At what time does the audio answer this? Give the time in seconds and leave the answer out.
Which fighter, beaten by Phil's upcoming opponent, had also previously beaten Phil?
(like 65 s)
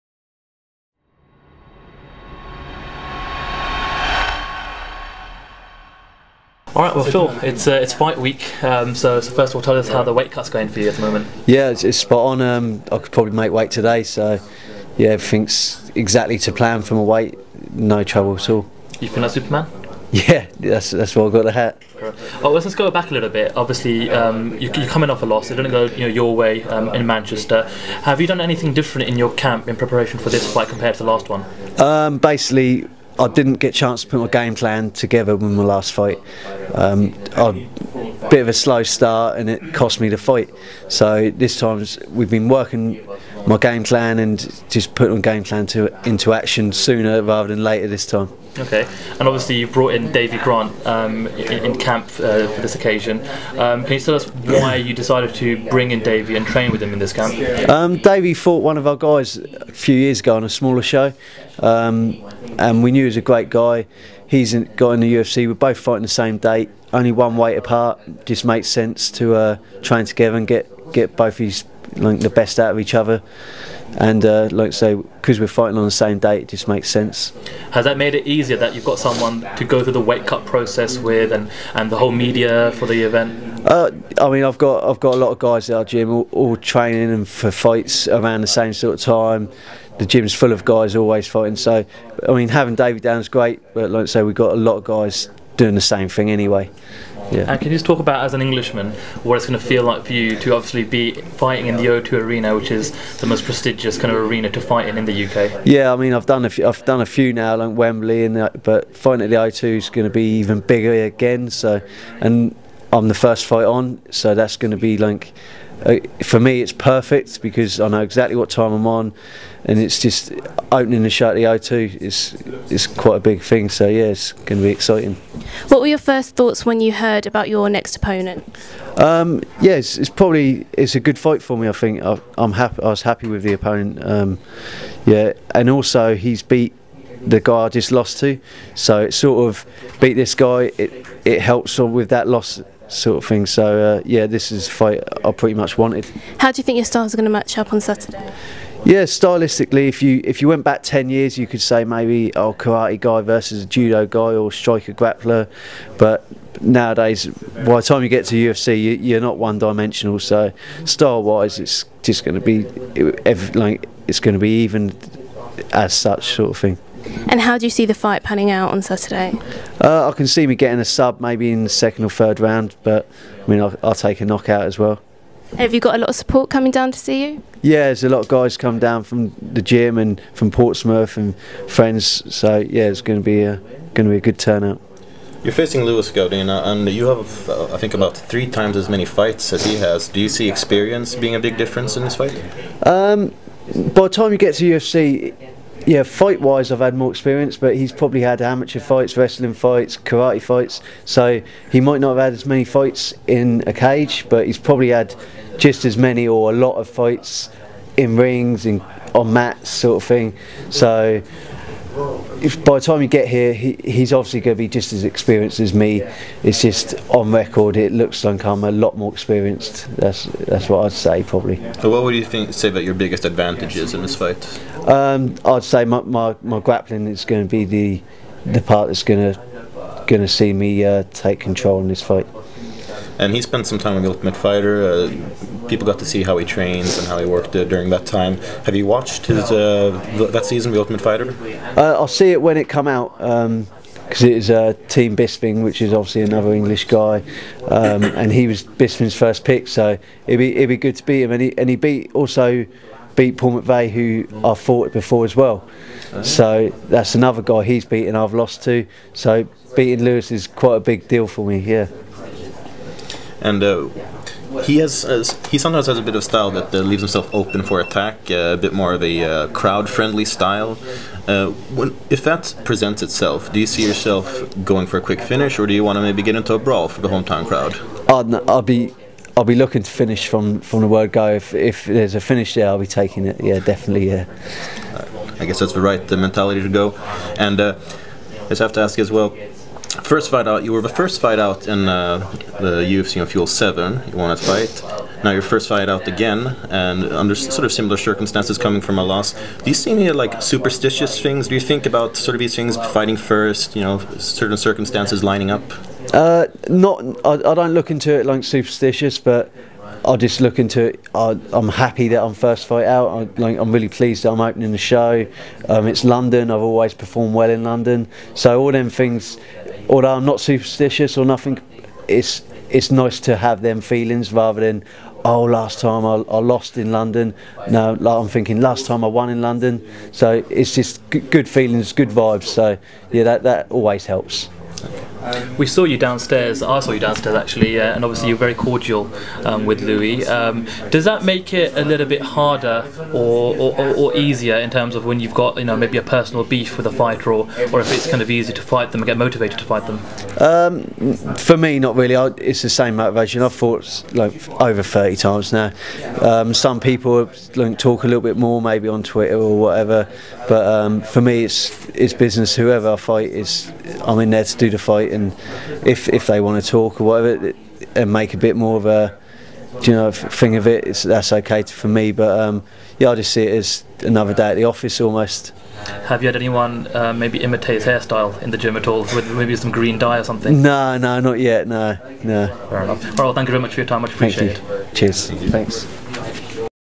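253 s.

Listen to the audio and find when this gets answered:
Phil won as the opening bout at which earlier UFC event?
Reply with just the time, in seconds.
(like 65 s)
292 s.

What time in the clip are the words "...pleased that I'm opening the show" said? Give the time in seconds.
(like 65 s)
313 s.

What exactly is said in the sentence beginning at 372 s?
But um, yeah, I just see it as another day at the office almost.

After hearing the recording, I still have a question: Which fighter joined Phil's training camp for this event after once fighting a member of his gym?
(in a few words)
Davy Grant.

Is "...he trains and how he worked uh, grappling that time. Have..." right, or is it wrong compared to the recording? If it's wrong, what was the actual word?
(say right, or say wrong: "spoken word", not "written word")
wrong: "during", not "grappling".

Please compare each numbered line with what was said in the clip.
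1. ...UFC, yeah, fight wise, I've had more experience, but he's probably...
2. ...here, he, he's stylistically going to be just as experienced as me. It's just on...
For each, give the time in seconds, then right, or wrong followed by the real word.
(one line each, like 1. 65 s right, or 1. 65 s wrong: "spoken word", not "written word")
1. 194 s right
2. 213 s wrong: "obviously", not "stylistically".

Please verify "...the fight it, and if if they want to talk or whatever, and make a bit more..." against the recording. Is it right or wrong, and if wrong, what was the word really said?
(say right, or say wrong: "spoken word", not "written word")
right.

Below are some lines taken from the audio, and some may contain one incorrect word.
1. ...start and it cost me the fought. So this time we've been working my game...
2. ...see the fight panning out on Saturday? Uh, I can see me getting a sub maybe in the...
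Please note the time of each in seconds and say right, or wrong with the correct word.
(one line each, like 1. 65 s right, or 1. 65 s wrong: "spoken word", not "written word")
1. 38 s wrong: "fight", not "fought"
2. 167 s right.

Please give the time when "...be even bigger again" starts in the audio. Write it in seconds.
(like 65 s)
110 s.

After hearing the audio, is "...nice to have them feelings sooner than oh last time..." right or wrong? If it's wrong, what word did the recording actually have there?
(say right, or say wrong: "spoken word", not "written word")
wrong: "rather", not "sooner".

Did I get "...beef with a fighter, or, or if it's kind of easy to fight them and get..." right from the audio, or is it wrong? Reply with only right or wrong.
right.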